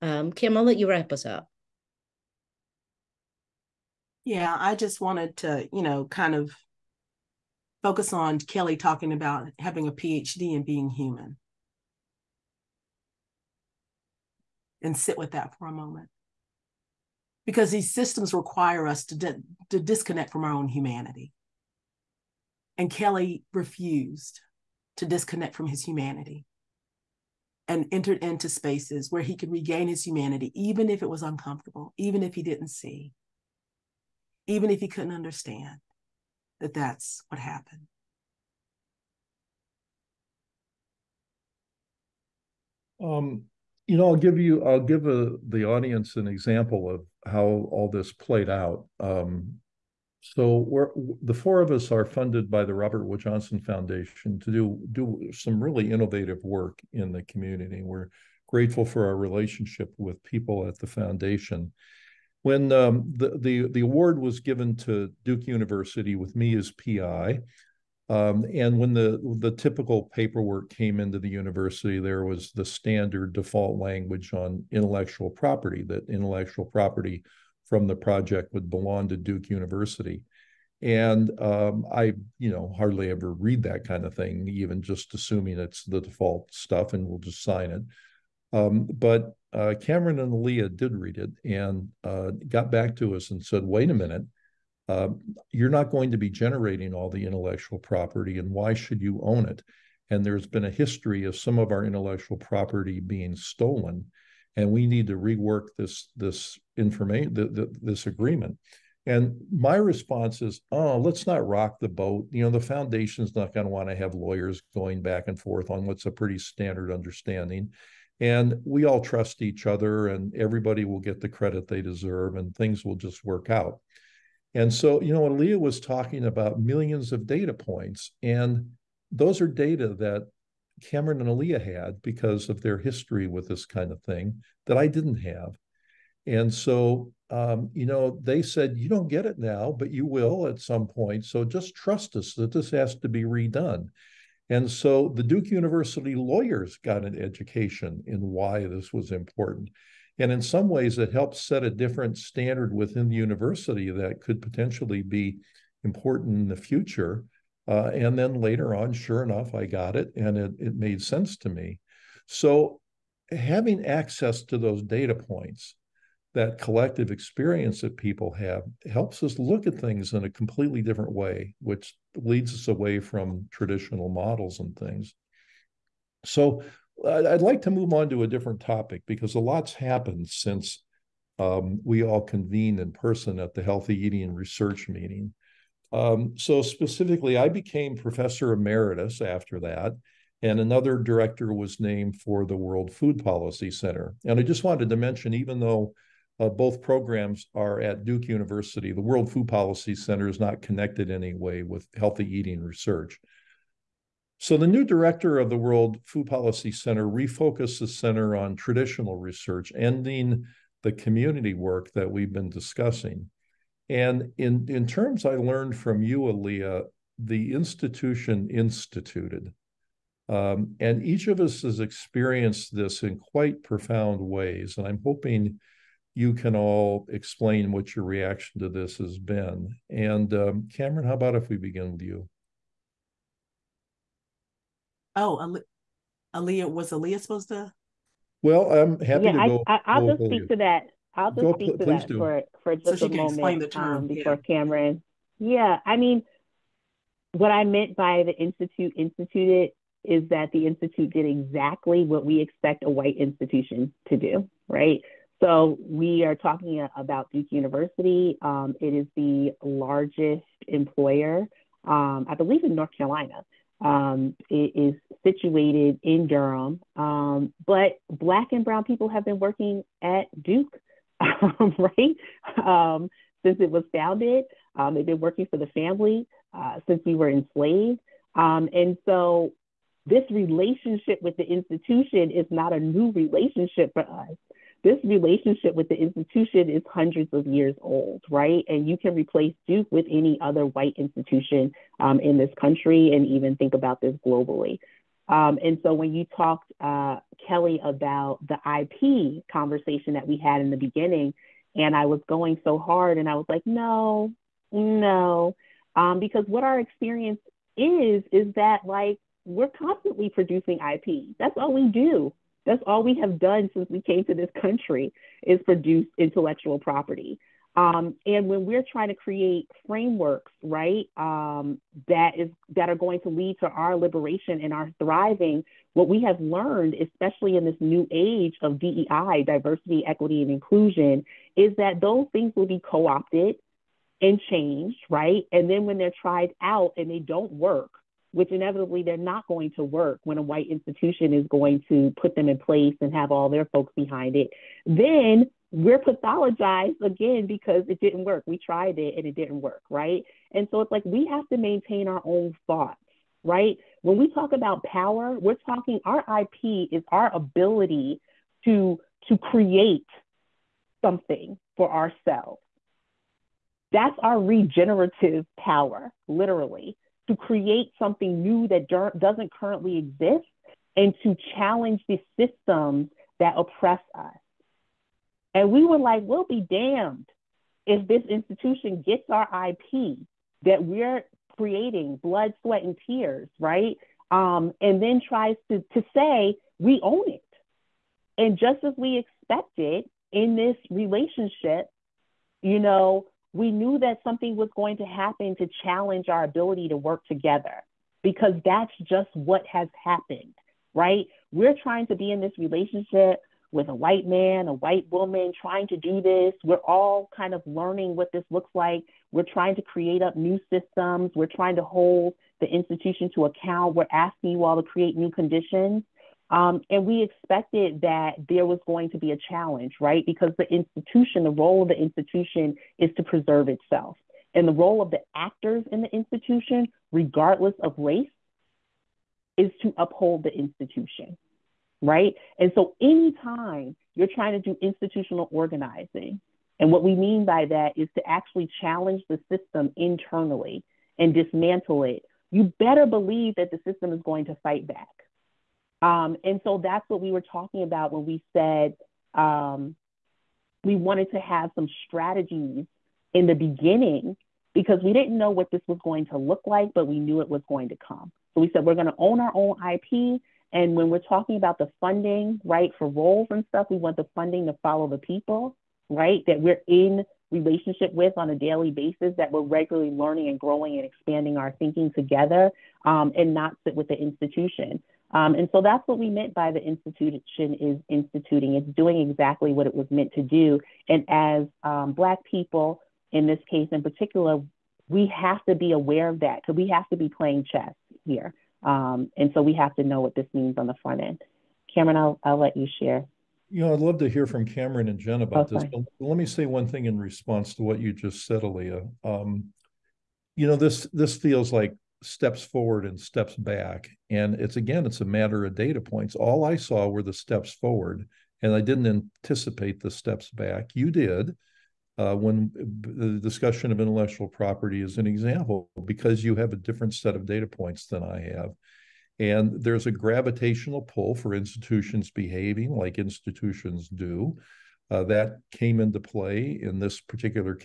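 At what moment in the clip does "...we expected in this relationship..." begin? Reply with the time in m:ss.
6:28.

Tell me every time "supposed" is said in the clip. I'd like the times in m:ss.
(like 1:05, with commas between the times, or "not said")
3:57.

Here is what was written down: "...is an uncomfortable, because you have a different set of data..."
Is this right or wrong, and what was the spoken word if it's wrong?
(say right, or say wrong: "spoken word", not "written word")
wrong: "example", not "uncomfortable".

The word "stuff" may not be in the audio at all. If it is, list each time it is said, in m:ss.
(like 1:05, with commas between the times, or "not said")
1:26, 7:43.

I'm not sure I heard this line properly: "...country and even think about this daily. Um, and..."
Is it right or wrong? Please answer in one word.
wrong.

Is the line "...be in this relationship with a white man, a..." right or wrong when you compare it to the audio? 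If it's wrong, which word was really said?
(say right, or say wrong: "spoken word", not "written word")
right.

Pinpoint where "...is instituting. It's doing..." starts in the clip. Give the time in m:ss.
7:57.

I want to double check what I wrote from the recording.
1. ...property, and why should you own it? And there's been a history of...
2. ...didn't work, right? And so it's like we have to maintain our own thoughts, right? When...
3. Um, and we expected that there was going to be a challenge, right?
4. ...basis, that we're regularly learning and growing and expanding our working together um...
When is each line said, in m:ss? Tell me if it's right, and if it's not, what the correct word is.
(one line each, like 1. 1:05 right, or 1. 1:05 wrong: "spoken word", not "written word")
1. 1:37 right
2. 5:49 right
3. 6:56 right
4. 7:48 wrong: "thinking", not "working".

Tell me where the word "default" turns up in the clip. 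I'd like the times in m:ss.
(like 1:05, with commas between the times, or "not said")
1:13, 1:26.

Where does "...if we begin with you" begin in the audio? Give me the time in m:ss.
3:51.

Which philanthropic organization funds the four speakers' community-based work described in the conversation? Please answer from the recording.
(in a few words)
Robert Wood Johnson Foundation.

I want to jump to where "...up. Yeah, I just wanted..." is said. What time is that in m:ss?
0:01.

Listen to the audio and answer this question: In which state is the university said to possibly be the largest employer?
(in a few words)
North Carolina.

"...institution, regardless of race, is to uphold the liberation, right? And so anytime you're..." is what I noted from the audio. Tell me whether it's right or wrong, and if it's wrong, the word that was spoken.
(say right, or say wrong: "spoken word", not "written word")
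wrong: "institution", not "liberation".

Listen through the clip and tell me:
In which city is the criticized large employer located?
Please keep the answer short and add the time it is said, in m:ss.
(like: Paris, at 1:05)
Durham, at 4:26.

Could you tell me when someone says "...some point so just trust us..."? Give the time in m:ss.
2:20.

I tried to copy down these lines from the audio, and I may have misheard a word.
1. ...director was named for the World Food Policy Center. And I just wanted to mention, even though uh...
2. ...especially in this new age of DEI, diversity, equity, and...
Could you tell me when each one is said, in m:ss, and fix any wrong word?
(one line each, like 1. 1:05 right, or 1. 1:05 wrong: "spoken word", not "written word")
1. 3:10 right
2. 5:26 right.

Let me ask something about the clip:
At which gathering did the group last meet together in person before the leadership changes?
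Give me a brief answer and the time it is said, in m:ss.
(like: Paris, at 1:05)
Healthy Eating Research meeting, at 3:03.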